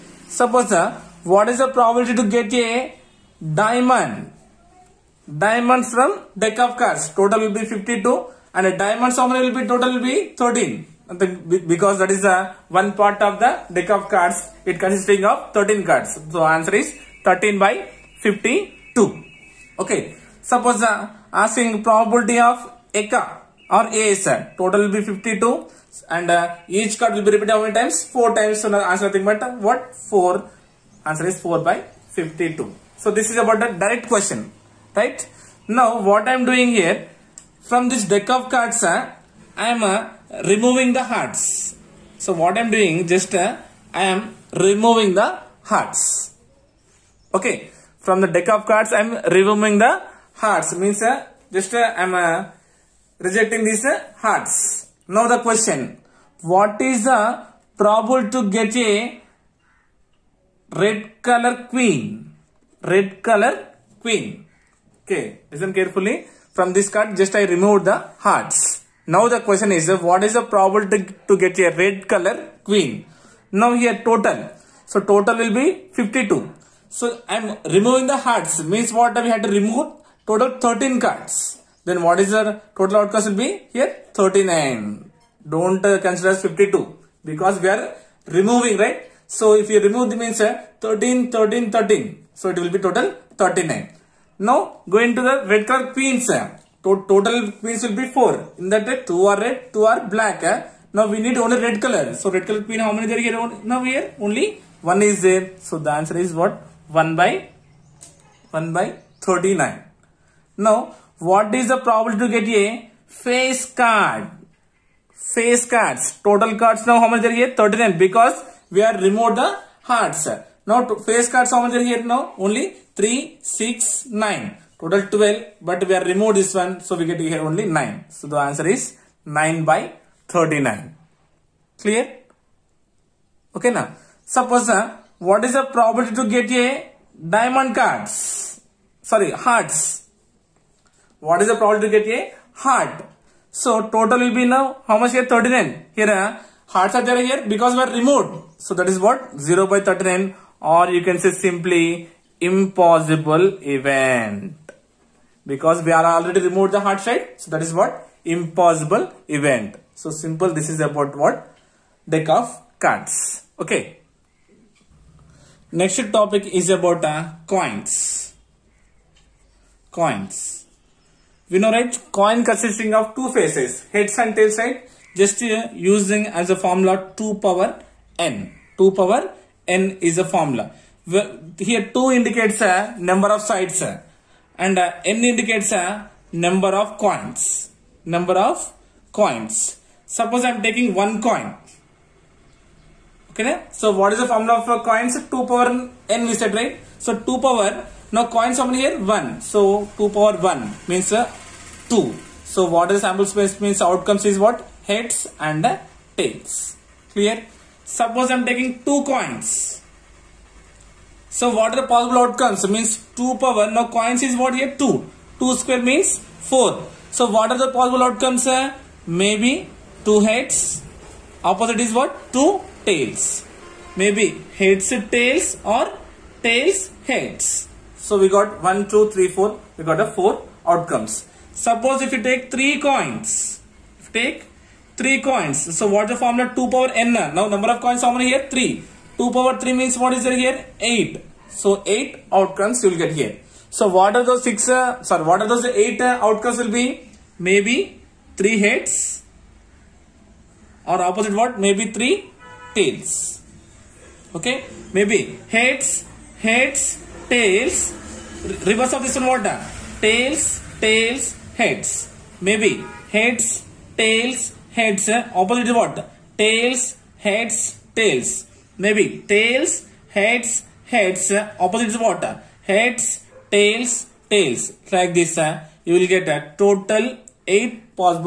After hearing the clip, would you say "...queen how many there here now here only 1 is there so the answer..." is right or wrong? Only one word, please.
right.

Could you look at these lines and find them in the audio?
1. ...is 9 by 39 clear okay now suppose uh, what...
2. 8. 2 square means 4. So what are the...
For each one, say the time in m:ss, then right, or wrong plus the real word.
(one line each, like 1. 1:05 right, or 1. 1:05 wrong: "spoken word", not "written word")
1. 2:08 right
2. 3:34 wrong: "2", not "8".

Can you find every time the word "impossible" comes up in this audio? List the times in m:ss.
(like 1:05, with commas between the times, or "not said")
2:32, 2:38.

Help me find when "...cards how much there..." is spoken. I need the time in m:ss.
2:01.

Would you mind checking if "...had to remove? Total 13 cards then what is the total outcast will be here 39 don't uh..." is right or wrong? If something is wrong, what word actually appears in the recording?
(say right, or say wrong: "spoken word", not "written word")
right.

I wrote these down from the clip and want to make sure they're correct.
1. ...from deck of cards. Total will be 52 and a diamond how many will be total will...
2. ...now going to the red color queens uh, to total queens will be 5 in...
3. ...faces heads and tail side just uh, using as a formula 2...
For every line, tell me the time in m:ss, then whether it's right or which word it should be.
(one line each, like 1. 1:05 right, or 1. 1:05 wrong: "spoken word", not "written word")
1. 0:05 right
2. 1:34 wrong: "4", not "5"
3. 2:53 right.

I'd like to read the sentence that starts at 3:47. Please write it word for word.
So we got one two three four.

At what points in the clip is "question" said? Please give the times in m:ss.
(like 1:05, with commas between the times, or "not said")
0:34, 0:55, 1:09.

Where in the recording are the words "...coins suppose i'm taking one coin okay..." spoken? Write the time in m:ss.
3:09.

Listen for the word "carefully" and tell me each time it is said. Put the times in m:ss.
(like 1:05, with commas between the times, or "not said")
1:05.